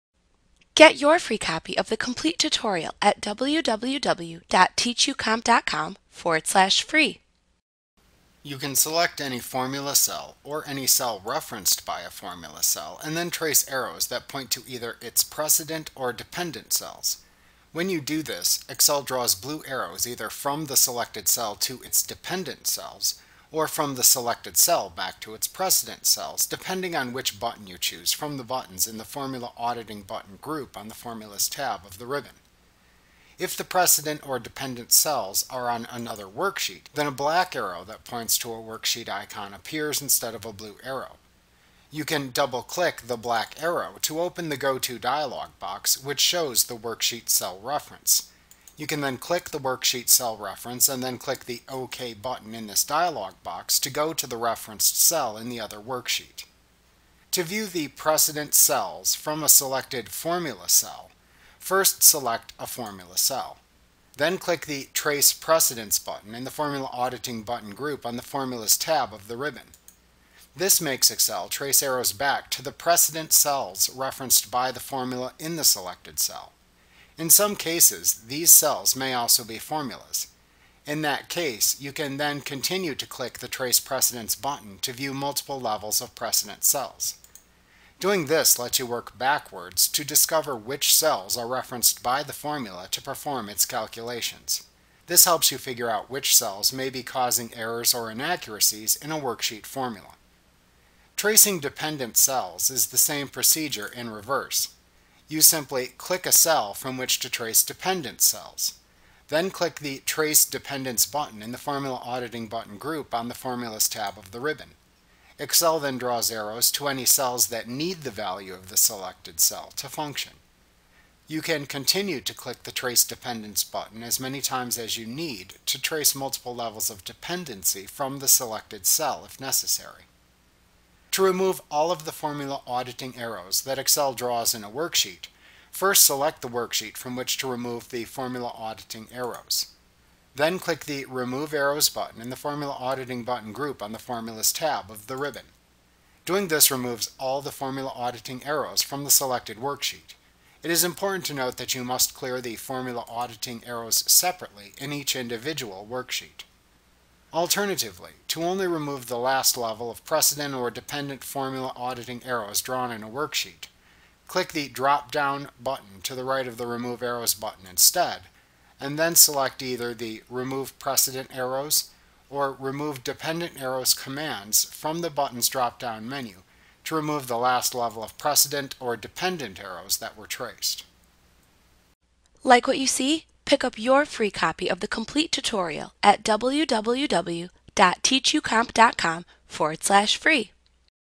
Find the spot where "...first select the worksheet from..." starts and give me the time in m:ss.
2:15.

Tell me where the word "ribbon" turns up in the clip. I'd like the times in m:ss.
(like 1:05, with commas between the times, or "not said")
0:32, 1:09, 1:54, 2:25.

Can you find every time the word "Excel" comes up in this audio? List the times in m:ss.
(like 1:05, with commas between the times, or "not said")
0:18, 1:11, 1:55, 2:13.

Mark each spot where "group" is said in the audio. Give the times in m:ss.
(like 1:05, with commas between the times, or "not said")
0:30, 1:07, 1:52, 2:23.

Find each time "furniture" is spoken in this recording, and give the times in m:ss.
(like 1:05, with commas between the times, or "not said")
not said.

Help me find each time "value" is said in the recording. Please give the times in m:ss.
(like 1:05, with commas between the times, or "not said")
1:58.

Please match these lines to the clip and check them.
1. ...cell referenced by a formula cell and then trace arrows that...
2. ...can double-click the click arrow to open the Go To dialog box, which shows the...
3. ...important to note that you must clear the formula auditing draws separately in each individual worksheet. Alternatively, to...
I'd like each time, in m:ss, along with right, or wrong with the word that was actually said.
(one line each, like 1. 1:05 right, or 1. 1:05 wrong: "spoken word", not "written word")
1. 0:10 right
2. 0:42 wrong: "black", not "click"
3. 2:30 wrong: "arrows", not "draws".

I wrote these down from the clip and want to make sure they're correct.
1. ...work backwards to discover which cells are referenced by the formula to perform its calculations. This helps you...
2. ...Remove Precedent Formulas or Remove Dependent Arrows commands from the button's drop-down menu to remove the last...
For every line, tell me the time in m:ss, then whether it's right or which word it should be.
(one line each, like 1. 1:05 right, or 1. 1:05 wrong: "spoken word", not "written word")
1. 1:28 right
2. 2:50 wrong: "Arrows", not "Formulas".